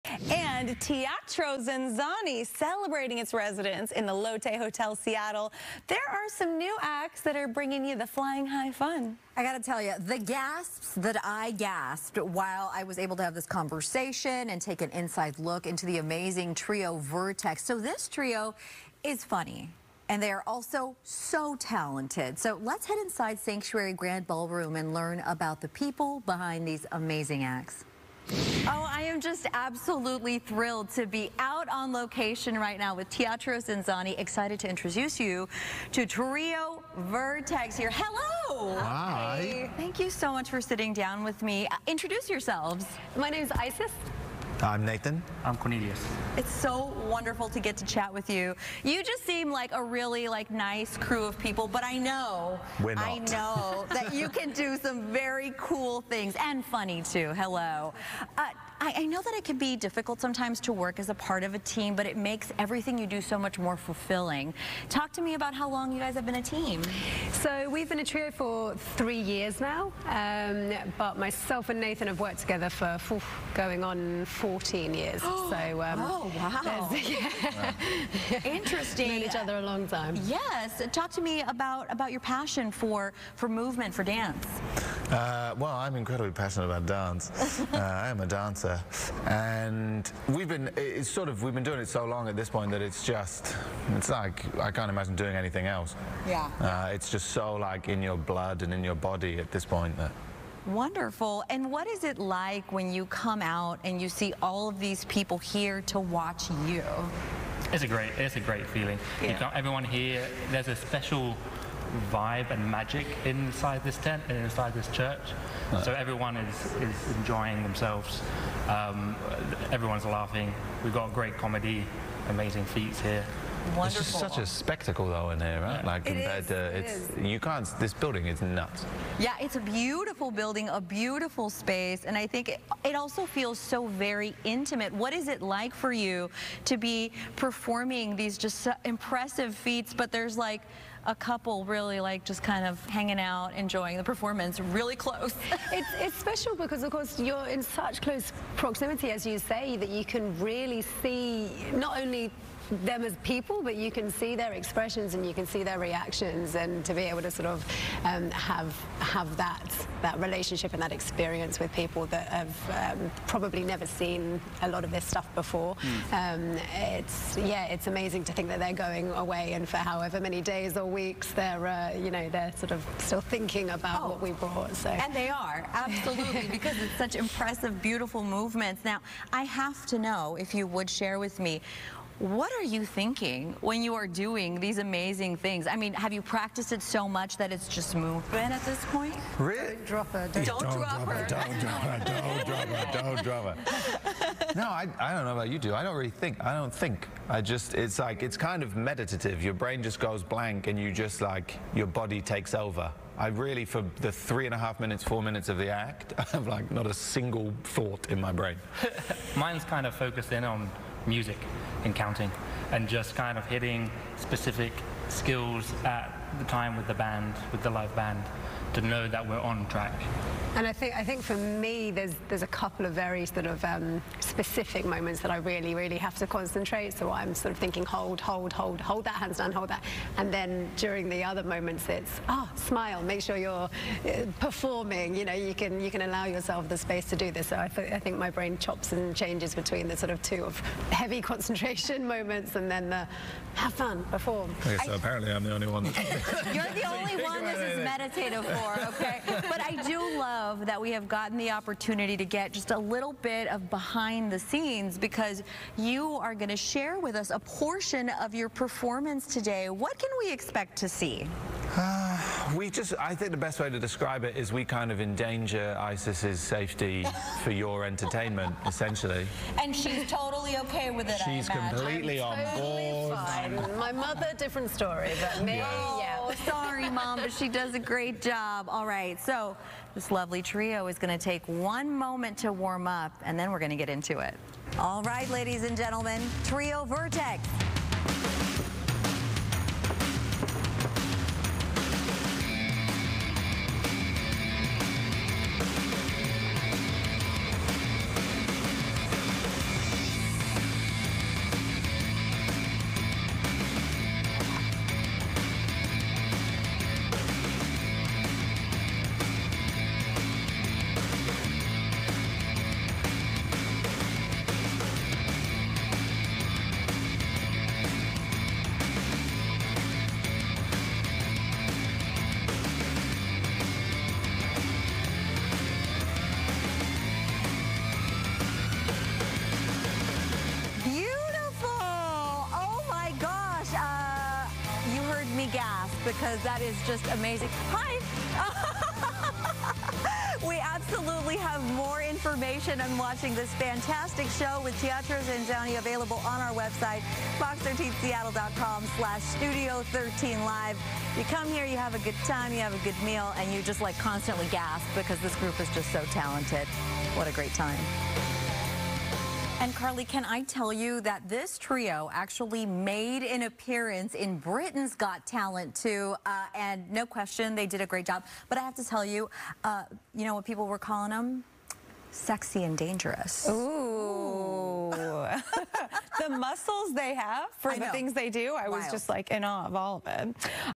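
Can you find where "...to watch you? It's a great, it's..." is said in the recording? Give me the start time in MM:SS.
01:45.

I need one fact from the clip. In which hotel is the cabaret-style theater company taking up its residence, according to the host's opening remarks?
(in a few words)
Lotte Hotel.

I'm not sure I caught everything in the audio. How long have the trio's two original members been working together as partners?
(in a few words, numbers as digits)
14 years.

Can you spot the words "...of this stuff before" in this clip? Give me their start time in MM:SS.
02:44.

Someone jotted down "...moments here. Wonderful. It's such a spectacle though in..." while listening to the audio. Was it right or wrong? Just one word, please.
wrong.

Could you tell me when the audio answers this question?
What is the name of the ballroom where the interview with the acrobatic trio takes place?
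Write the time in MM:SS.
00:23.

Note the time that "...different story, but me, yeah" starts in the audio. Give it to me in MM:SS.
04:34.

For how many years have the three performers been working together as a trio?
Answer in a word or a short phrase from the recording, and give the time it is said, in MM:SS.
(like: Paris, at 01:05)
3 years, at 01:08.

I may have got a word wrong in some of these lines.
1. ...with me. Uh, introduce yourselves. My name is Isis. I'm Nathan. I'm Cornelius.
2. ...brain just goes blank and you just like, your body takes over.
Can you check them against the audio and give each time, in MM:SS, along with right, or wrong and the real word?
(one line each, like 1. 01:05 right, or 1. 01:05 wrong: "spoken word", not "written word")
1. 00:41 right
2. 03:19 right.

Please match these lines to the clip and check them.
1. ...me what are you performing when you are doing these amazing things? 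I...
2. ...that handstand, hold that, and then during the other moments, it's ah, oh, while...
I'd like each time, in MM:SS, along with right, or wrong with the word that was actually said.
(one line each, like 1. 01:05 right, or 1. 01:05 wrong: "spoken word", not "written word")
1. 03:01 wrong: "thinking", not "performing"
2. 03:49 wrong: "smile", not "while".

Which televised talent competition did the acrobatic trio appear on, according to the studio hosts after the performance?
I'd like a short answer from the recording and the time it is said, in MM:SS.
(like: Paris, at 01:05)
Britain's Got Talent, at 06:04.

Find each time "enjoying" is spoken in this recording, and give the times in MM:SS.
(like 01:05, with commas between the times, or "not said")
01:57, 02:23.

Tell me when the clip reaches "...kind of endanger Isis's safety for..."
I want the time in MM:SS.
04:24.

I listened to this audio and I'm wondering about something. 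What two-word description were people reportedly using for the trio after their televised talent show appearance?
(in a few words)
Sexy and dangerous.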